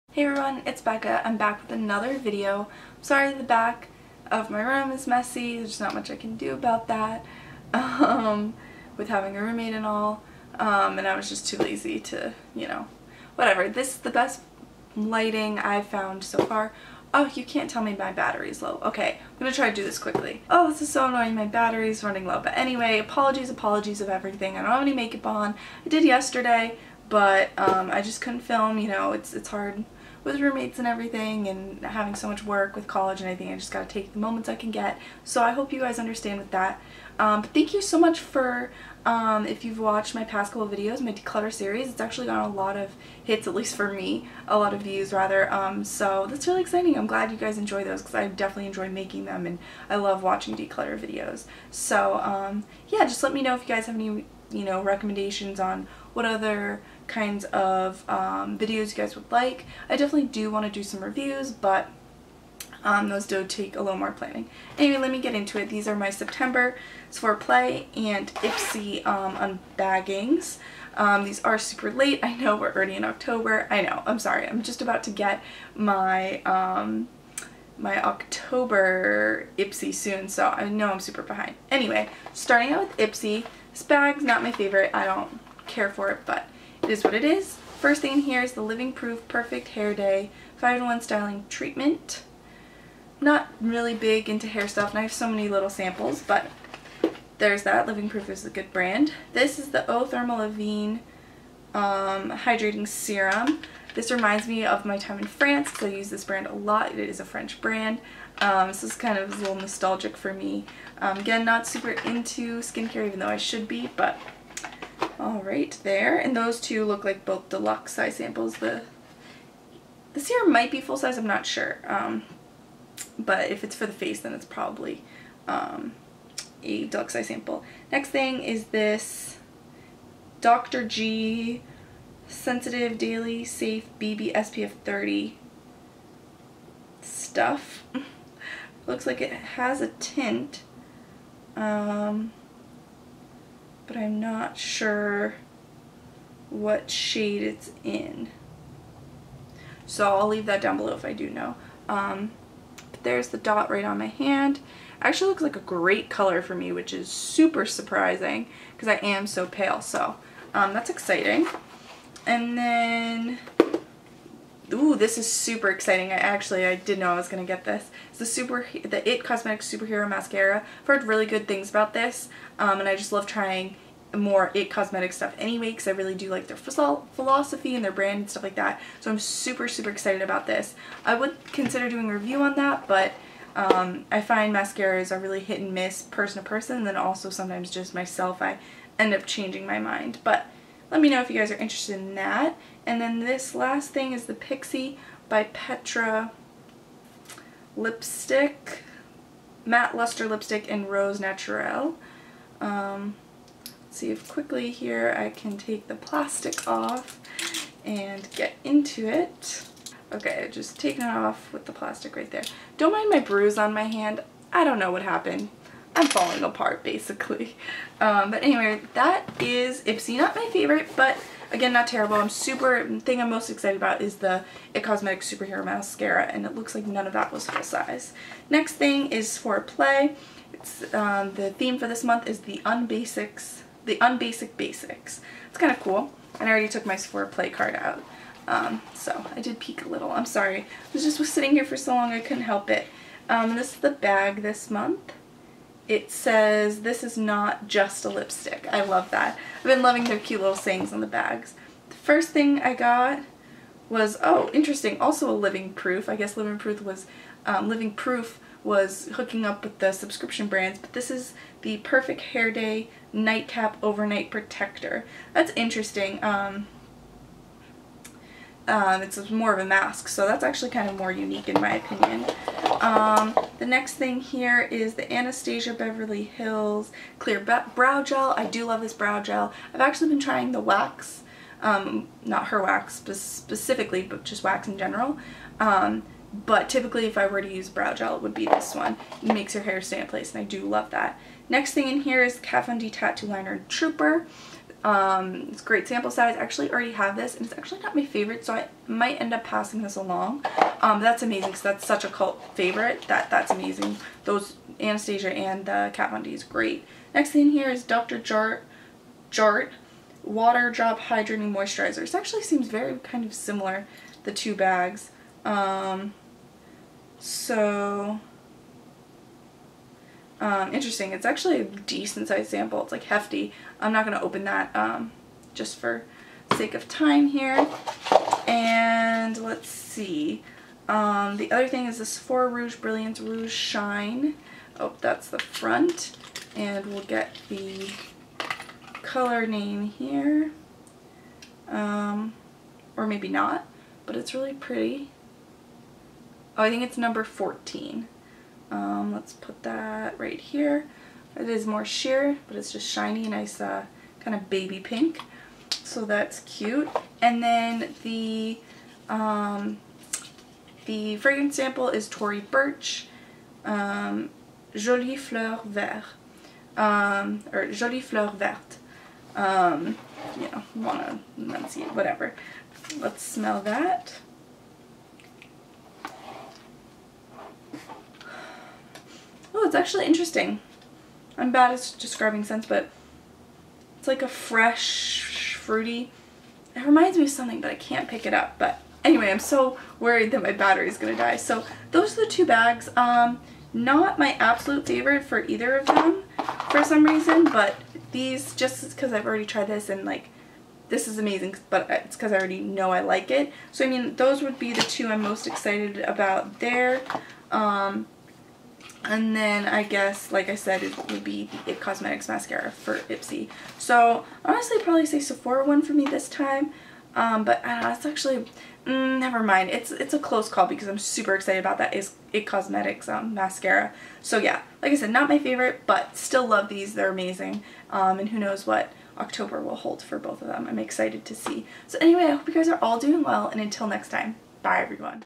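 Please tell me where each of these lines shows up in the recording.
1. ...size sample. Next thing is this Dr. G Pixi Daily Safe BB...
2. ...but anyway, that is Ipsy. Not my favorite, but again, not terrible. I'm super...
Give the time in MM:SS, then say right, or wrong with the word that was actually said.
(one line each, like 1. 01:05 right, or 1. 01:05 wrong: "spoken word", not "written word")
1. 02:07 wrong: "Sensitive", not "Pixi"
2. 03:38 right.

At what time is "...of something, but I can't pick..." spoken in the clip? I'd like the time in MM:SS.
06:27.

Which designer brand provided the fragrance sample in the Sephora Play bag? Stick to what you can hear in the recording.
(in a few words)
Tory Burch.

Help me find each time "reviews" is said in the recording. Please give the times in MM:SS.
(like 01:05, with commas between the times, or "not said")
01:01, 03:02.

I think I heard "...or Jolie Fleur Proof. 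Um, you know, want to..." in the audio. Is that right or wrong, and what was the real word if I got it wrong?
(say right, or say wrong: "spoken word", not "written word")
wrong: "Verte", not "Proof".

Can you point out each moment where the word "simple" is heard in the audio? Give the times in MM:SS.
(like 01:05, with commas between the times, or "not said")
not said.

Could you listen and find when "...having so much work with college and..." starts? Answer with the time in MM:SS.
00:31.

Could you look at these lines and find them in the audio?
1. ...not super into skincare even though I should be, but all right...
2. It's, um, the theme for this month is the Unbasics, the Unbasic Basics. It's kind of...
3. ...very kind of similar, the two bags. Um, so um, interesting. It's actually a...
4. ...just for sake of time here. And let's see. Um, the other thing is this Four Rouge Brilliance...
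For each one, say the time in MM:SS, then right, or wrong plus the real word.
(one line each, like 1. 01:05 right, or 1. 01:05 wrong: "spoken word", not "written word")
1. 01:51 right
2. 03:50 right
3. 05:12 right
4. 05:25 right.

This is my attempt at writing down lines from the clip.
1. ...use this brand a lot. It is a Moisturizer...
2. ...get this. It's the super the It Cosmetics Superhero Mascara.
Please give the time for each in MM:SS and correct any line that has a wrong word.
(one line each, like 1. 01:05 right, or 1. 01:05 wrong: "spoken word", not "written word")
1. 01:45 wrong: "French", not "Moisturizer"
2. 02:47 right.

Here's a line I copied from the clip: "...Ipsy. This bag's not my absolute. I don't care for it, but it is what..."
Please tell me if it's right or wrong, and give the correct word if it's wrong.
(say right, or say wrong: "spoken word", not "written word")
wrong: "favorite", not "absolute".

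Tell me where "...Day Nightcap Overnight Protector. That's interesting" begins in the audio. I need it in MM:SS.
04:22.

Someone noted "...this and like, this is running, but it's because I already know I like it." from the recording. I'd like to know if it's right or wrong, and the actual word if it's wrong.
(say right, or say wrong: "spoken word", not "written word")
wrong: "amazing", not "running".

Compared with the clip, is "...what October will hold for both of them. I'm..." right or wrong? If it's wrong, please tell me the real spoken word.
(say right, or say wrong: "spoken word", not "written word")
right.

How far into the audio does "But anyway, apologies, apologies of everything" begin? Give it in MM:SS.
00:22.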